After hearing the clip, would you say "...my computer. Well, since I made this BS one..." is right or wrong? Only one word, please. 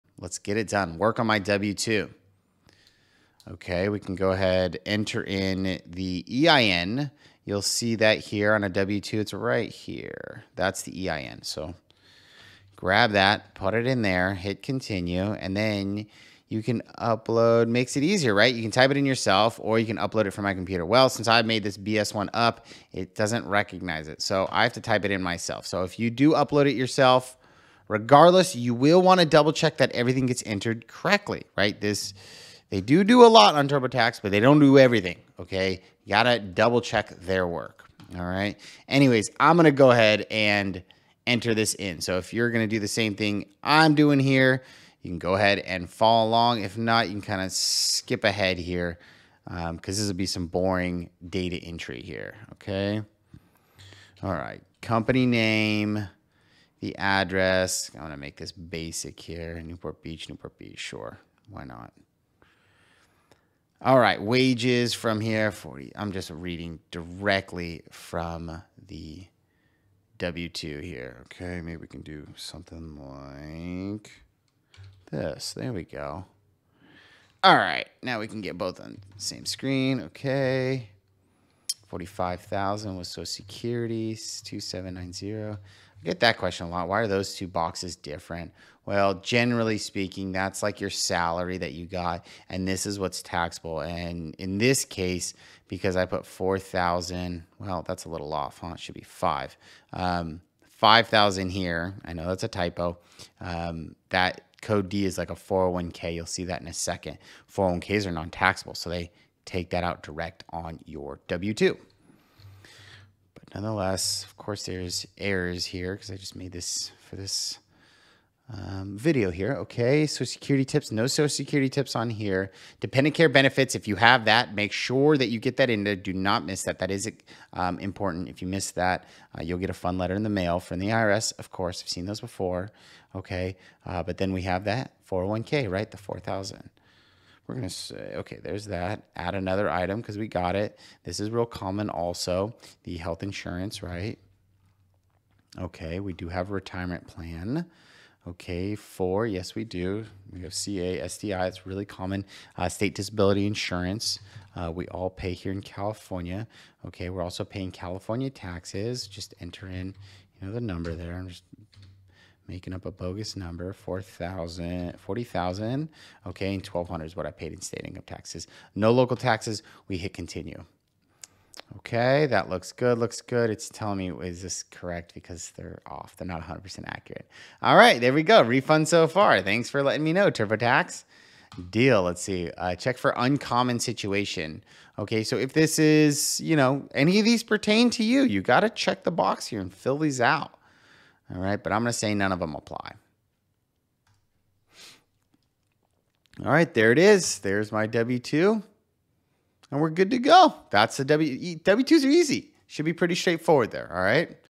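right.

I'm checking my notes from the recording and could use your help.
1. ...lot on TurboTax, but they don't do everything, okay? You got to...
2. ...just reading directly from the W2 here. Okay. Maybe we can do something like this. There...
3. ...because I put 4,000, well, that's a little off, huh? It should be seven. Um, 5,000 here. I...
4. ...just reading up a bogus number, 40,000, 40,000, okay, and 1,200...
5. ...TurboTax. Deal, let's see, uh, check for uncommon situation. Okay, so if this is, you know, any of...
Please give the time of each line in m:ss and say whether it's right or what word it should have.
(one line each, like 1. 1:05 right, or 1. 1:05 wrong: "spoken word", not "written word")
1. 0:33 right
2. 1:06 right
3. 1:35 wrong: "five", not "seven"
4. 2:41 wrong: "making", not "reading"
5. 3:00 right.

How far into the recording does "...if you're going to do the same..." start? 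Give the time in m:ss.
0:42.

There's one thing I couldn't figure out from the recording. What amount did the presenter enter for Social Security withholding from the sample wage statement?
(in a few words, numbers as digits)
2790.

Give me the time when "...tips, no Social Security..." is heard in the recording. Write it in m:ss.
2:00.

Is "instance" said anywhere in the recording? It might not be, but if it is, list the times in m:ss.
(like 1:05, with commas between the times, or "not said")
not said.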